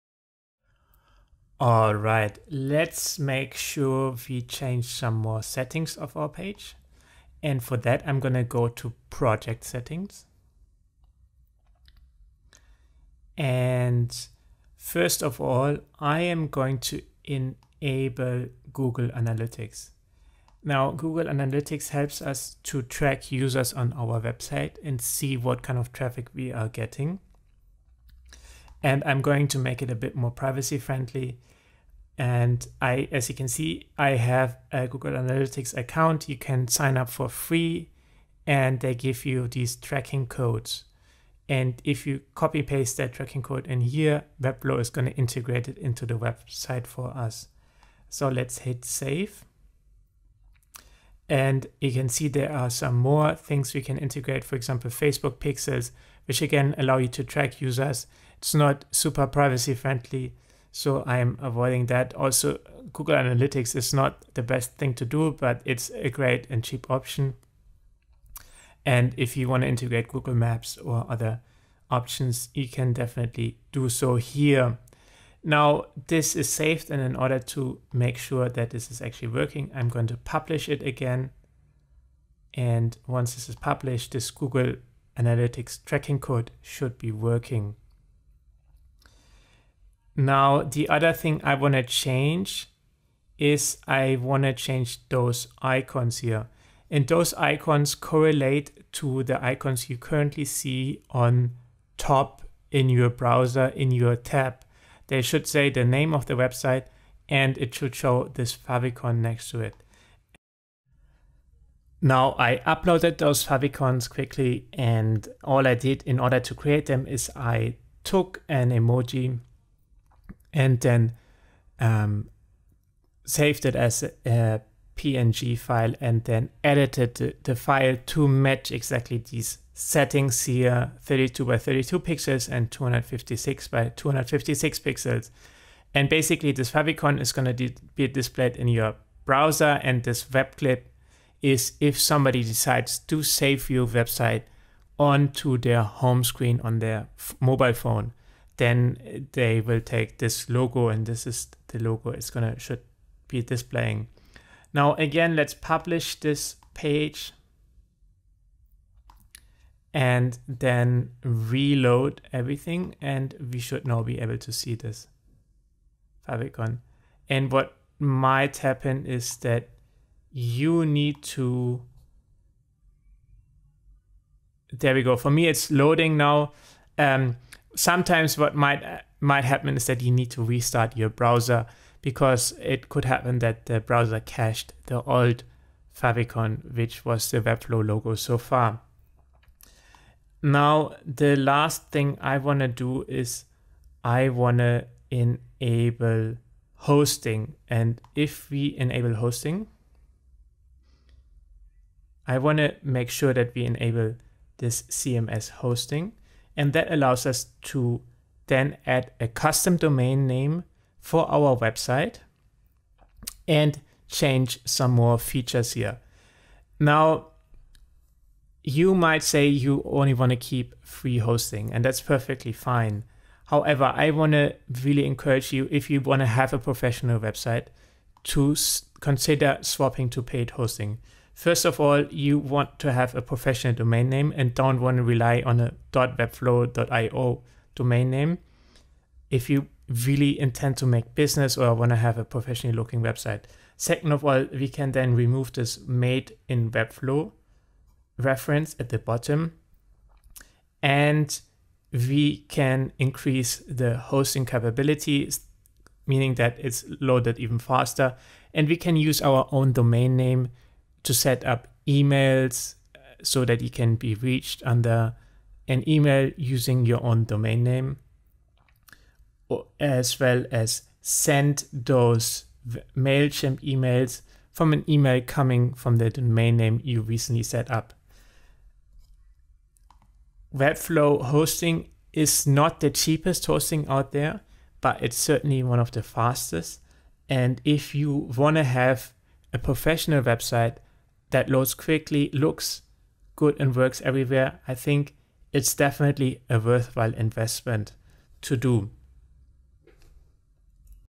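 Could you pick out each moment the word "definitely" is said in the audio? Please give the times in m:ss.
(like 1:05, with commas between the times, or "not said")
1:12, 4:55.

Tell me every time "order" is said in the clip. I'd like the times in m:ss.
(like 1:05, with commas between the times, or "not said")
1:17, 1:56.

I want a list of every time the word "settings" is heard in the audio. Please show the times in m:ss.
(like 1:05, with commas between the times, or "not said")
0:05, 0:09, 2:09.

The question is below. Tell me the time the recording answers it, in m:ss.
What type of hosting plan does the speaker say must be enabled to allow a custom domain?
3:24.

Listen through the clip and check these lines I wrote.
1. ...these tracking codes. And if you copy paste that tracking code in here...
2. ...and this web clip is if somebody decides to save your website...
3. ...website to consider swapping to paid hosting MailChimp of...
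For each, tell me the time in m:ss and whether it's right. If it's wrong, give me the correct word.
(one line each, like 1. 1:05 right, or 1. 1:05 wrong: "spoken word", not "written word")
1. 0:39 right
2. 2:19 right
3. 3:47 wrong: "First", not "MailChimp".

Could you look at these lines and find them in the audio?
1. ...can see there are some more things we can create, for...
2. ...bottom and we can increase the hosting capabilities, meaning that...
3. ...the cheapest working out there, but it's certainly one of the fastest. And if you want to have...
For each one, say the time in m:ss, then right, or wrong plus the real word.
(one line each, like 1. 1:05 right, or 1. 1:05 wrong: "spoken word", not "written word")
1. 0:51 wrong: "integrate", not "create"
2. 4:08 right
3. 4:42 wrong: "hosting", not "working".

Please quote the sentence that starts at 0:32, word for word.
And I, as you can see, I have a Google Analytics account.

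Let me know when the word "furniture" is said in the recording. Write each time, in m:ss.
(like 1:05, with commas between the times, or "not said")
not said.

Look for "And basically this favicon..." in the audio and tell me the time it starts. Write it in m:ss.
2:15.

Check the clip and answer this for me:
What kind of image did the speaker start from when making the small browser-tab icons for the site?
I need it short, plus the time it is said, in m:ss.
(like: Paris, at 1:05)
an emoji, at 1:58.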